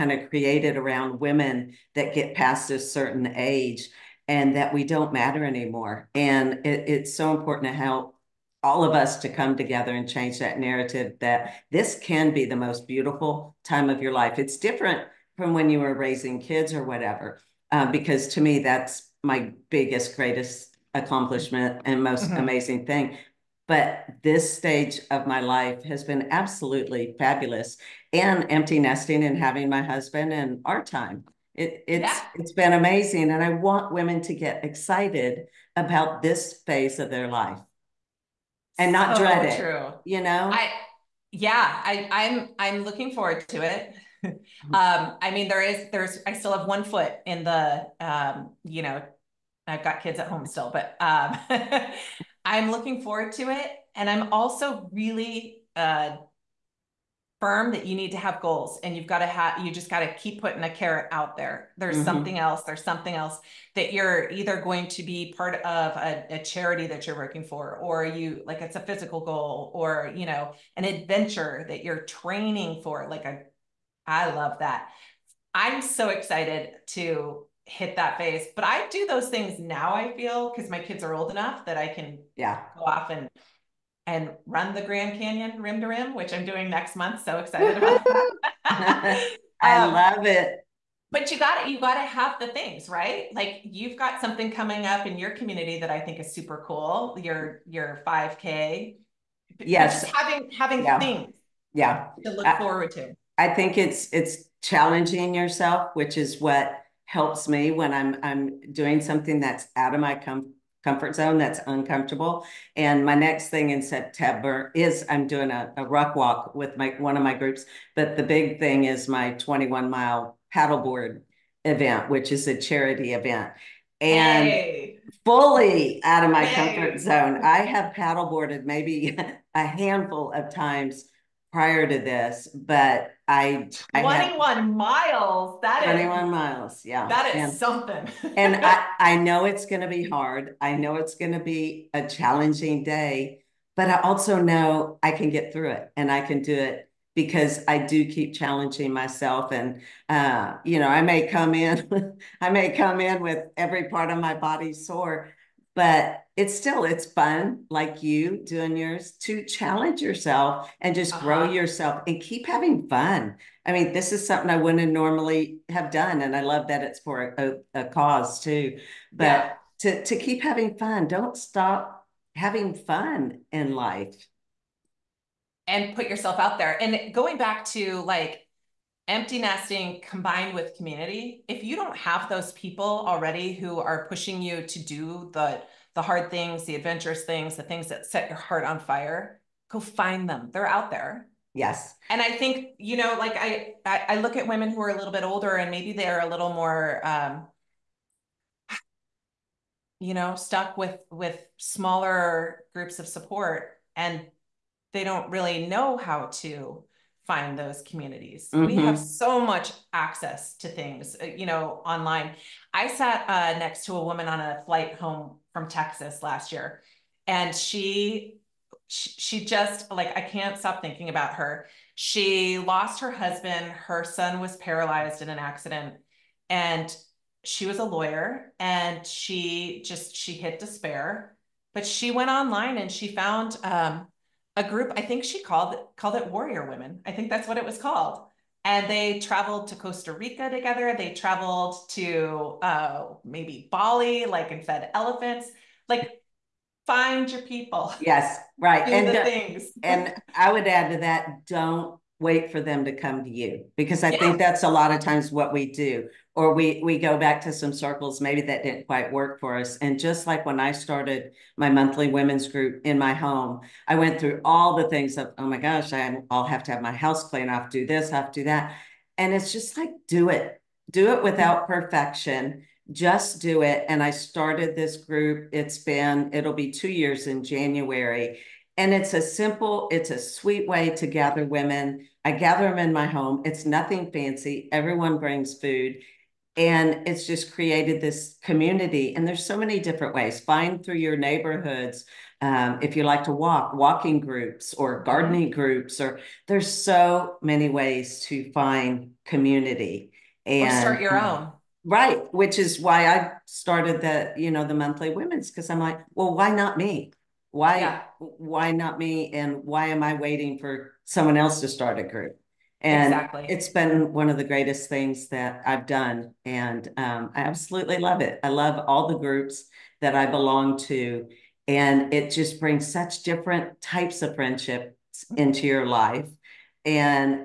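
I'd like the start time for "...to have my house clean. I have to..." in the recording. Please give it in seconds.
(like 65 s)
266 s.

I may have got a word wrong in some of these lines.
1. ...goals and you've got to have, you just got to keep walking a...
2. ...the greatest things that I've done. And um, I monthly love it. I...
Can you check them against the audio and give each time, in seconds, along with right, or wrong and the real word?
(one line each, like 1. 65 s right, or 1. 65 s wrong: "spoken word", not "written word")
1. 58 s wrong: "putting", not "walking"
2. 314 s wrong: "absolutely", not "monthly".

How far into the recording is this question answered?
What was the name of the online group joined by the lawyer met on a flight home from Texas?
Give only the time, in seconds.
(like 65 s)
236 s.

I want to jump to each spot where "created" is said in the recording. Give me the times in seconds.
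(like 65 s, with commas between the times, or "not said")
0 s, 287 s.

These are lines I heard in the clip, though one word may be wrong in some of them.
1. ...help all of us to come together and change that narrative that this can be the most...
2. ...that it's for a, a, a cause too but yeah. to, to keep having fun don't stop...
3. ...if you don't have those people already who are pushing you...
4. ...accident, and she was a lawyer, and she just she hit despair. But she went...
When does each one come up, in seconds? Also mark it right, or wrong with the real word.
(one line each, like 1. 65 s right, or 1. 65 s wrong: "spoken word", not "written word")
1. 7 s right
2. 166 s right
3. 181 s right
4. 225 s right.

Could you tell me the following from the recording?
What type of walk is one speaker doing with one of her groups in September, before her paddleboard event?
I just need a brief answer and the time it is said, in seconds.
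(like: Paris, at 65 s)
ruck walk, at 115 s.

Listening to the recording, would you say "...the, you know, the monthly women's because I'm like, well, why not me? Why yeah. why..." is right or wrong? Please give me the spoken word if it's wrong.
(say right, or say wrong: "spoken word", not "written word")
right.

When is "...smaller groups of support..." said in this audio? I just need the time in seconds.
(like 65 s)
201 s.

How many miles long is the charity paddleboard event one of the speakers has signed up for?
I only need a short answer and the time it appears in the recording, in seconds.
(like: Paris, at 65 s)
21, at 119 s.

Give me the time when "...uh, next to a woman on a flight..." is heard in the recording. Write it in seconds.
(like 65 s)
213 s.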